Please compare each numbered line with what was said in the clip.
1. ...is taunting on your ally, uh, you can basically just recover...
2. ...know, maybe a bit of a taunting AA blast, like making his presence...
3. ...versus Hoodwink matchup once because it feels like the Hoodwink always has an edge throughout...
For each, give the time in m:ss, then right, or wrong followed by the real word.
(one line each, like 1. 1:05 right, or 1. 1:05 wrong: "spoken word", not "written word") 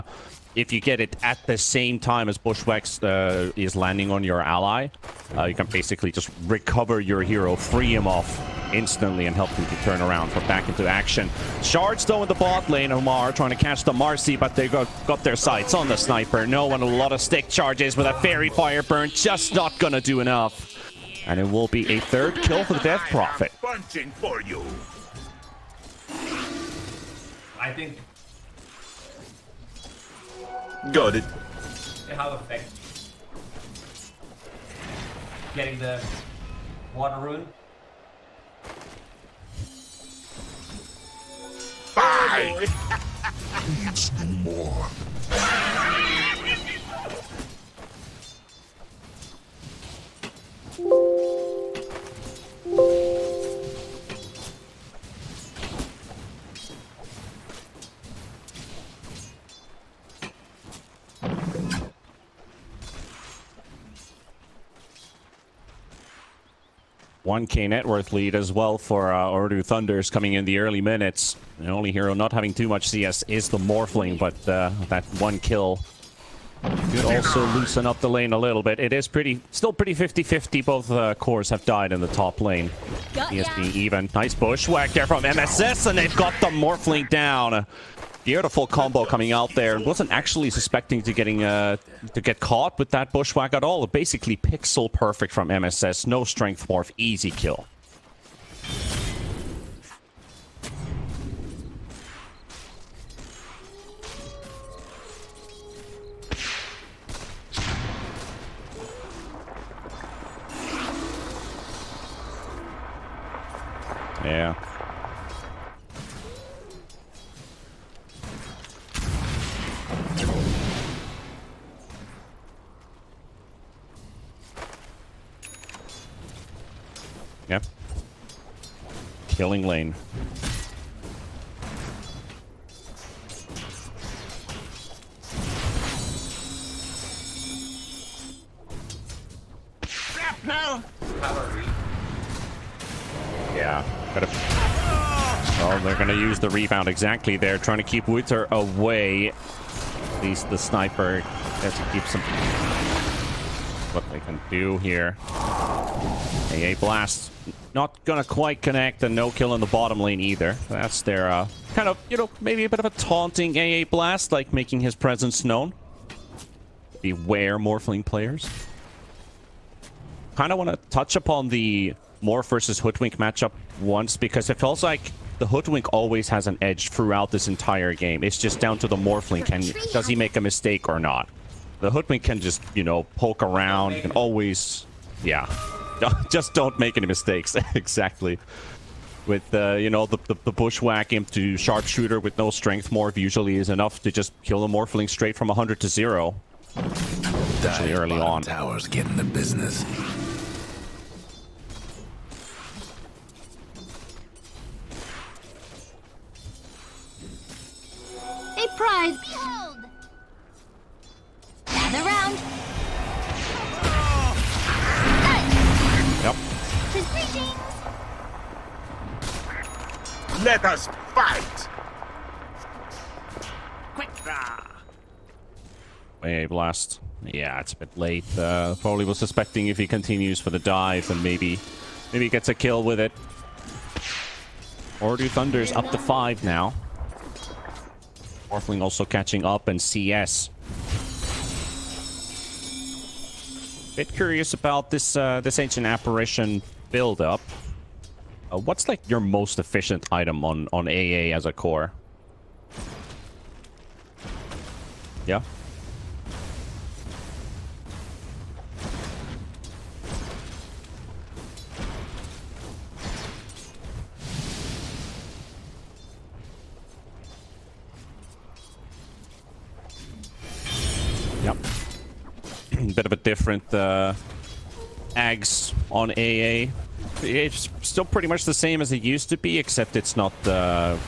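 1. 0:03 wrong: "landing", not "taunting"
2. 2:42 right
3. 2:52 right.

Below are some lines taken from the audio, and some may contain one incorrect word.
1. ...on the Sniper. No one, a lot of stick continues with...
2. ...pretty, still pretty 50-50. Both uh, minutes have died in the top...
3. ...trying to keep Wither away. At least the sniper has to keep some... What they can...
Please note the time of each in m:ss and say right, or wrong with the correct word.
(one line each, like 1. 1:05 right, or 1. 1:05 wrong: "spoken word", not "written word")
1. 0:15 wrong: "charges", not "continues"
2. 1:19 wrong: "cores", not "minutes"
3. 2:27 right.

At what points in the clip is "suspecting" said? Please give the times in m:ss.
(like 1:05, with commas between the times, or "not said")
1:30, 3:49.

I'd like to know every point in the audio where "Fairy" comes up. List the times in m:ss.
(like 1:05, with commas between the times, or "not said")
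0:18.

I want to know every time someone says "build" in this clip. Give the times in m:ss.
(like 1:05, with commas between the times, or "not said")
4:06.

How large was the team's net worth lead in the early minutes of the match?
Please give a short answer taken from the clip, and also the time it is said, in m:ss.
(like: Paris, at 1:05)
1k, at 1:07.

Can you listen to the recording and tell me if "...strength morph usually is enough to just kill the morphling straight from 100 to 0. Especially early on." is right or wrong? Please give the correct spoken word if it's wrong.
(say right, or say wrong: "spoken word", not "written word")
right.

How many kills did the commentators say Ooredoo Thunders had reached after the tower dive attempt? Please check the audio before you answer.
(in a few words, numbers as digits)
5.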